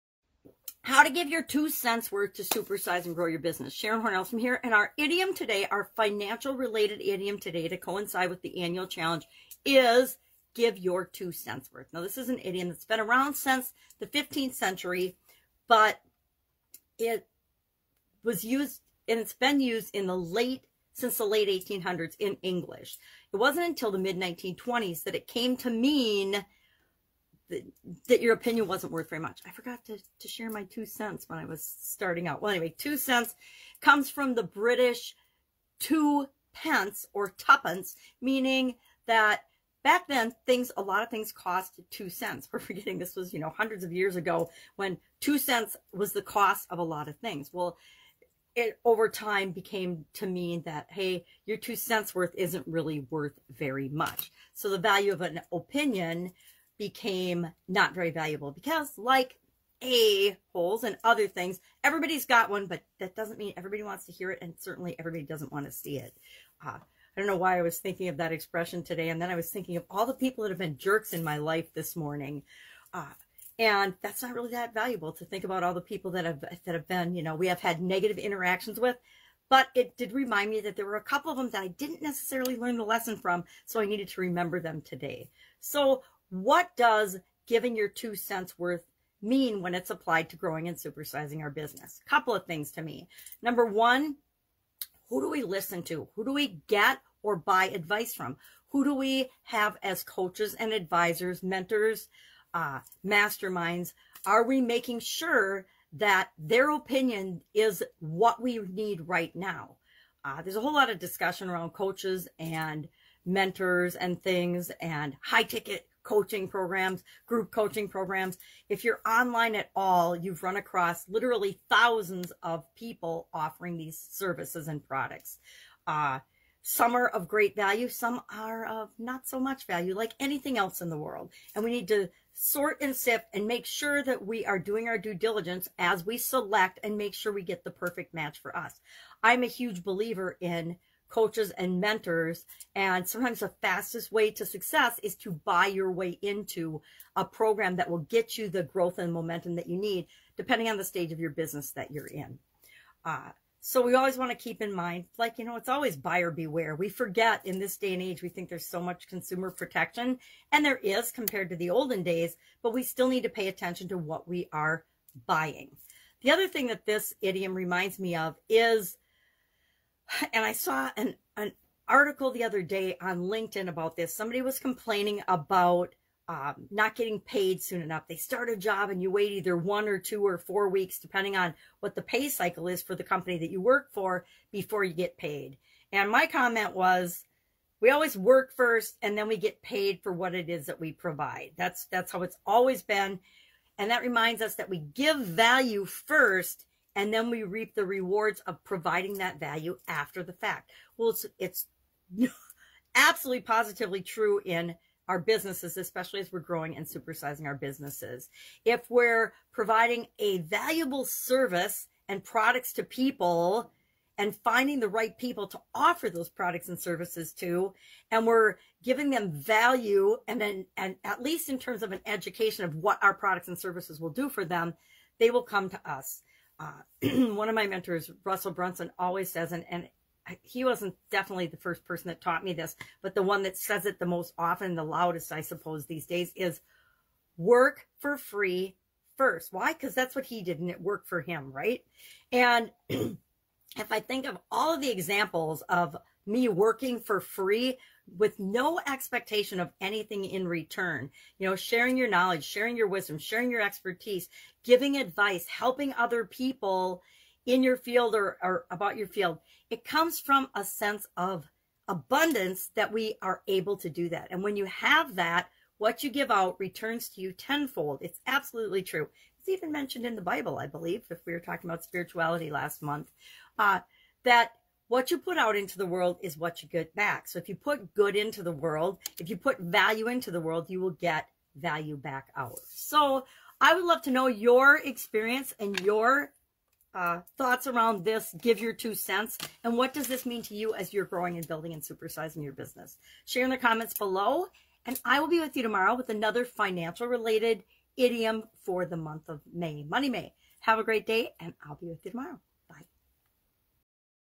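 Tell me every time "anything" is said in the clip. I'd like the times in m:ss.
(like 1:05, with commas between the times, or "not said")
2:10, 4:09.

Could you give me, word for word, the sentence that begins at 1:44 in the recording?
Are we making sure that their opinion is what we need right now?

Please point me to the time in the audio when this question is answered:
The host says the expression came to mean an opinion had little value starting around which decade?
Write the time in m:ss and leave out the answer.
0:23.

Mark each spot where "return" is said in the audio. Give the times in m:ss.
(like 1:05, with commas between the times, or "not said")
4:10, 4:26.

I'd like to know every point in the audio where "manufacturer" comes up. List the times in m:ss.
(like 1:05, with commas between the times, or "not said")
not said.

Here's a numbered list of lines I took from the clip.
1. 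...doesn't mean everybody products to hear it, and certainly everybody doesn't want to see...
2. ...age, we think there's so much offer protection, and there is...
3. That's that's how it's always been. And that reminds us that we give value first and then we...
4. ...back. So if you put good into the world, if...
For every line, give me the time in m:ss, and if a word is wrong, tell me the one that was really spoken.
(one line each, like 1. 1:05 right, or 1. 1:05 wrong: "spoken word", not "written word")
1. 1:03 wrong: "wants", not "products"
2. 2:38 wrong: "consumer", not "offer"
3. 3:11 right
4. 4:36 right.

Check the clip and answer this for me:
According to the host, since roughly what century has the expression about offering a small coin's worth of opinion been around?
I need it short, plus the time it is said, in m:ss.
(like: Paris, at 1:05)
15th century, at 0:14.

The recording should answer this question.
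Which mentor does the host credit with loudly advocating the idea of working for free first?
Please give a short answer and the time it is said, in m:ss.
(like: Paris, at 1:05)
Russell Brunson, at 3:48.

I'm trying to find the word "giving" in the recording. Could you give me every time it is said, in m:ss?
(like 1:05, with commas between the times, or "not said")
1:27, 3:38, 4:14.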